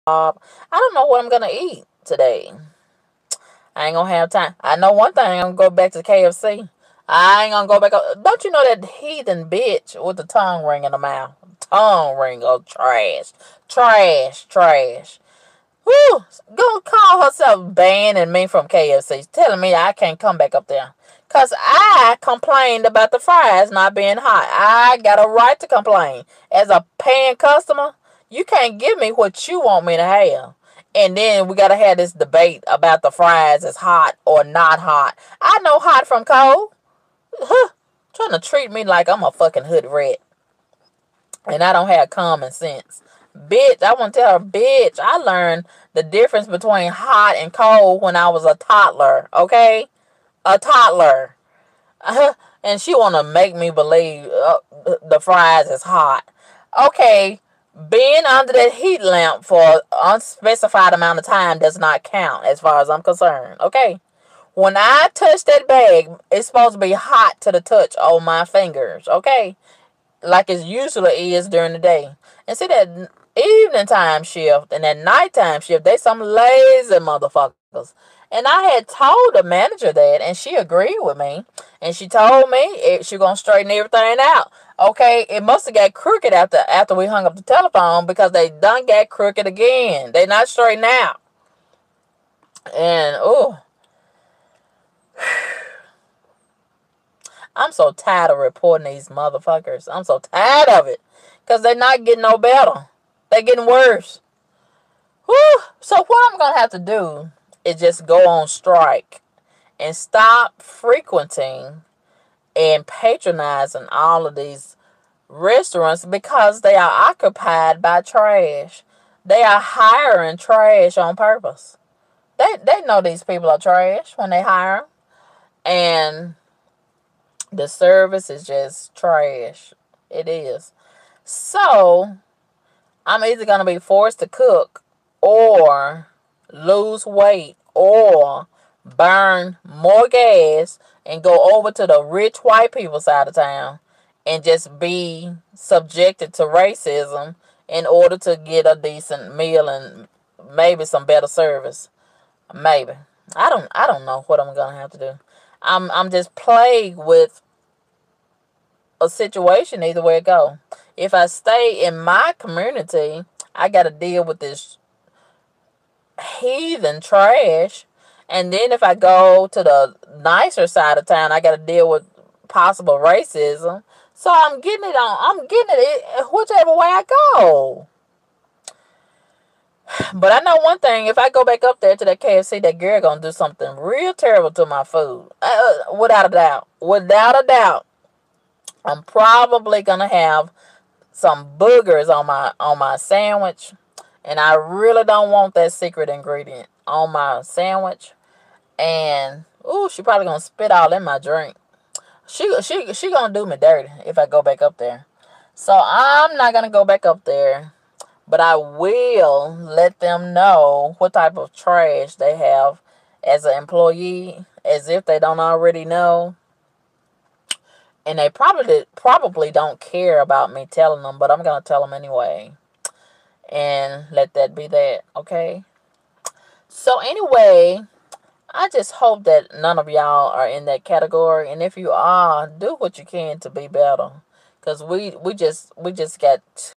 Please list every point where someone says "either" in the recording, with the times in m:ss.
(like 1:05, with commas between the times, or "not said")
2:13, 2:39.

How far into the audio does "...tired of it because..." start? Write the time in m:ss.
1:40.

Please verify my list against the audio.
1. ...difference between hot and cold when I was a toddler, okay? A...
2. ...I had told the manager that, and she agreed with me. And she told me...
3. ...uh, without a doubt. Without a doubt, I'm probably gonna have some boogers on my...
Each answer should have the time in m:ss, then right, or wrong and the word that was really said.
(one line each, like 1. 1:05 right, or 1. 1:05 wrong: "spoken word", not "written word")
1. 0:46 right
2. 1:18 right
3. 3:05 right.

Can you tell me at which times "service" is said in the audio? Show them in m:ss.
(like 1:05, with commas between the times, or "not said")
2:07, 2:31.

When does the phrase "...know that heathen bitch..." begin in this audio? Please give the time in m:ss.
0:08.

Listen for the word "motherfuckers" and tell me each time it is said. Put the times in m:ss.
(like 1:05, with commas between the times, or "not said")
1:16, 1:39.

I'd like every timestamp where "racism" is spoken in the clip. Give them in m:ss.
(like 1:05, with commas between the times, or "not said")
2:26, 2:52.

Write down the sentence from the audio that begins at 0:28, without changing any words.
You can't give me what you want me to have.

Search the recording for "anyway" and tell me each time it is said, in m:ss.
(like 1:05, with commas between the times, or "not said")
3:41, 3:47.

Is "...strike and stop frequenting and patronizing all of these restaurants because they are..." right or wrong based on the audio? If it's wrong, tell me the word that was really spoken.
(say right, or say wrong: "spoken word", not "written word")
right.